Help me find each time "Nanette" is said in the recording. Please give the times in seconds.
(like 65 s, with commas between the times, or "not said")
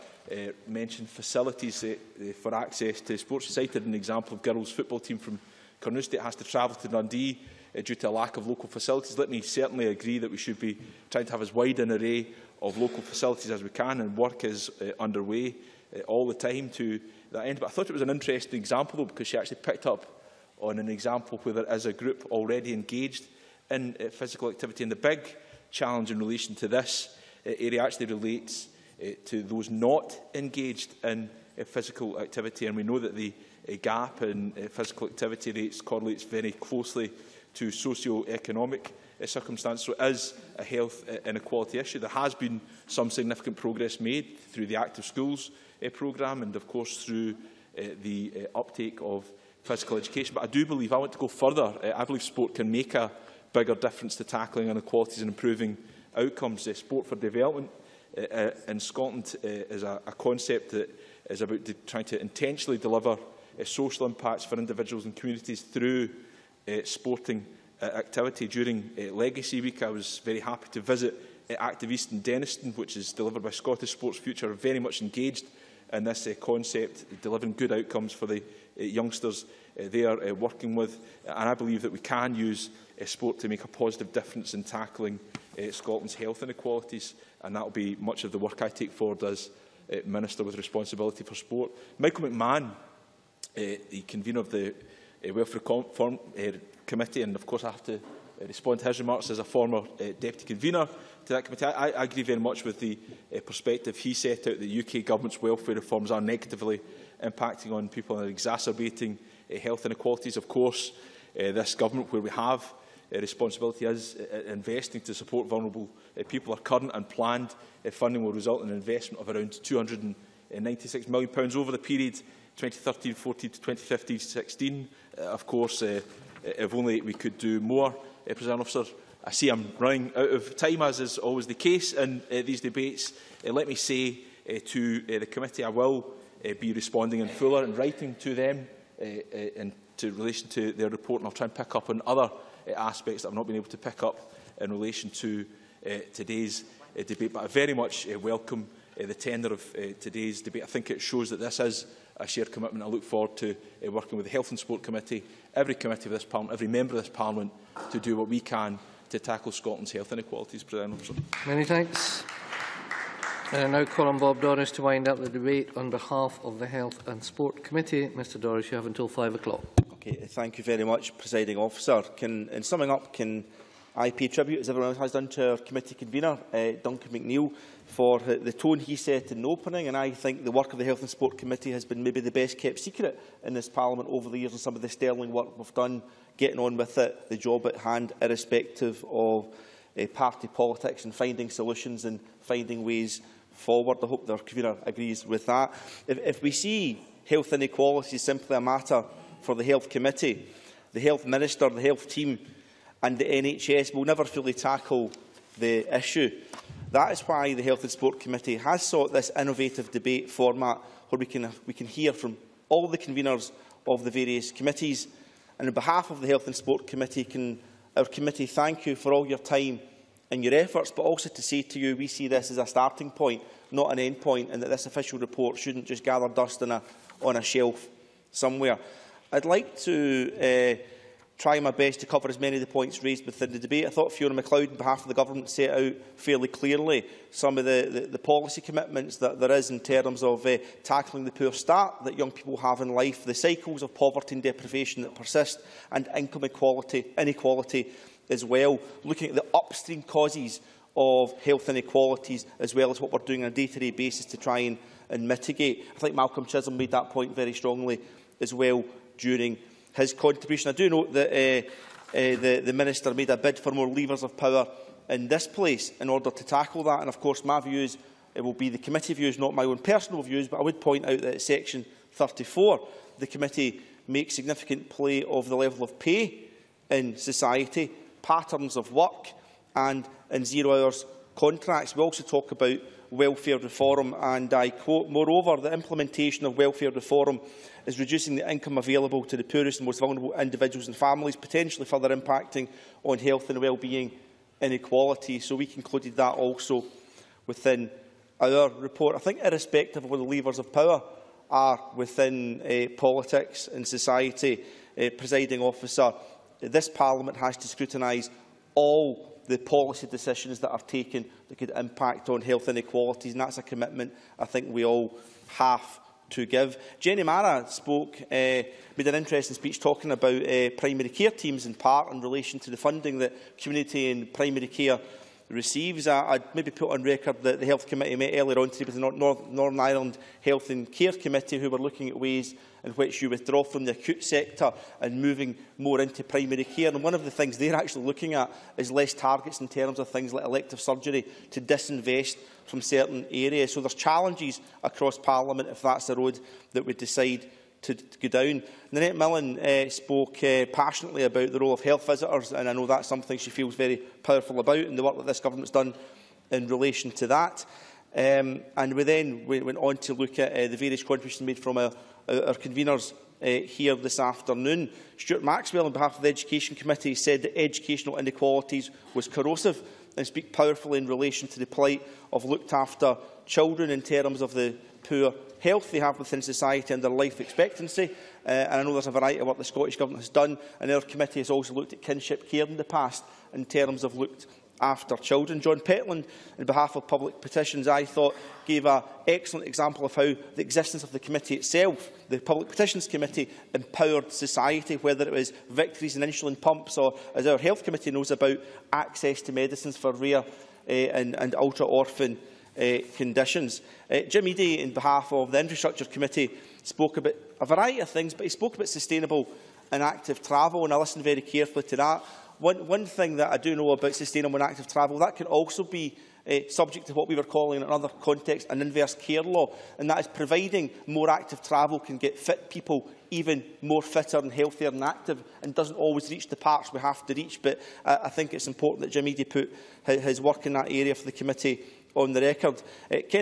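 348 s.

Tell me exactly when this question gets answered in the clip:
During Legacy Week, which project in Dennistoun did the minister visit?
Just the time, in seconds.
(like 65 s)
71 s.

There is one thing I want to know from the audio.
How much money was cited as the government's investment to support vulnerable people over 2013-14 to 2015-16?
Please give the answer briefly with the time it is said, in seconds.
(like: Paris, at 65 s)
£296 million, at 119 s.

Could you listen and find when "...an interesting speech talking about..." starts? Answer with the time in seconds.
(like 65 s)
319 s.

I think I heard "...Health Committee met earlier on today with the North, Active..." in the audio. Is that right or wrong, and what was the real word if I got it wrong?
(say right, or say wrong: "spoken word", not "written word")
wrong: "Northern", not "Active".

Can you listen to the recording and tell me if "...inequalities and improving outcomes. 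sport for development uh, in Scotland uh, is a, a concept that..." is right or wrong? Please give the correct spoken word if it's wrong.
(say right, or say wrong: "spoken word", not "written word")
right.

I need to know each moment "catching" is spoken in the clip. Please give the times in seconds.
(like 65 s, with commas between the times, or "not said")
not said.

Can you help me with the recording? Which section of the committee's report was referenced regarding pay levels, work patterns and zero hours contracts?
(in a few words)
Section 34.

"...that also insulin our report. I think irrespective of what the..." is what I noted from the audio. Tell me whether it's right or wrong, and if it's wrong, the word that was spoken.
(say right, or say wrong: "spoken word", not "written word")
wrong: "within", not "insulin".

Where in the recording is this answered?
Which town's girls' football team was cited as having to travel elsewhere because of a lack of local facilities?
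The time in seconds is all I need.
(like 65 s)
5 s.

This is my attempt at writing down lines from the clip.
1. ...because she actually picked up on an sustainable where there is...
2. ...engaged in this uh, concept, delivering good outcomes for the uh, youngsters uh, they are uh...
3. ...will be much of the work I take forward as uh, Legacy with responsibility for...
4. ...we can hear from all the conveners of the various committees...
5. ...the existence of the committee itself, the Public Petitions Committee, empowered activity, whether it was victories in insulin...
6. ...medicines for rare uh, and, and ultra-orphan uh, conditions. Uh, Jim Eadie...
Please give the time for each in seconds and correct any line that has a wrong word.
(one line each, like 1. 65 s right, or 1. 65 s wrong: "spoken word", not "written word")
1. 19 s wrong: "example", not "sustainable"
2. 75 s right
3. 87 s wrong: "Minister", not "Legacy"
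4. 211 s right
5. 390 s wrong: "society", not "activity"
6. 399 s right.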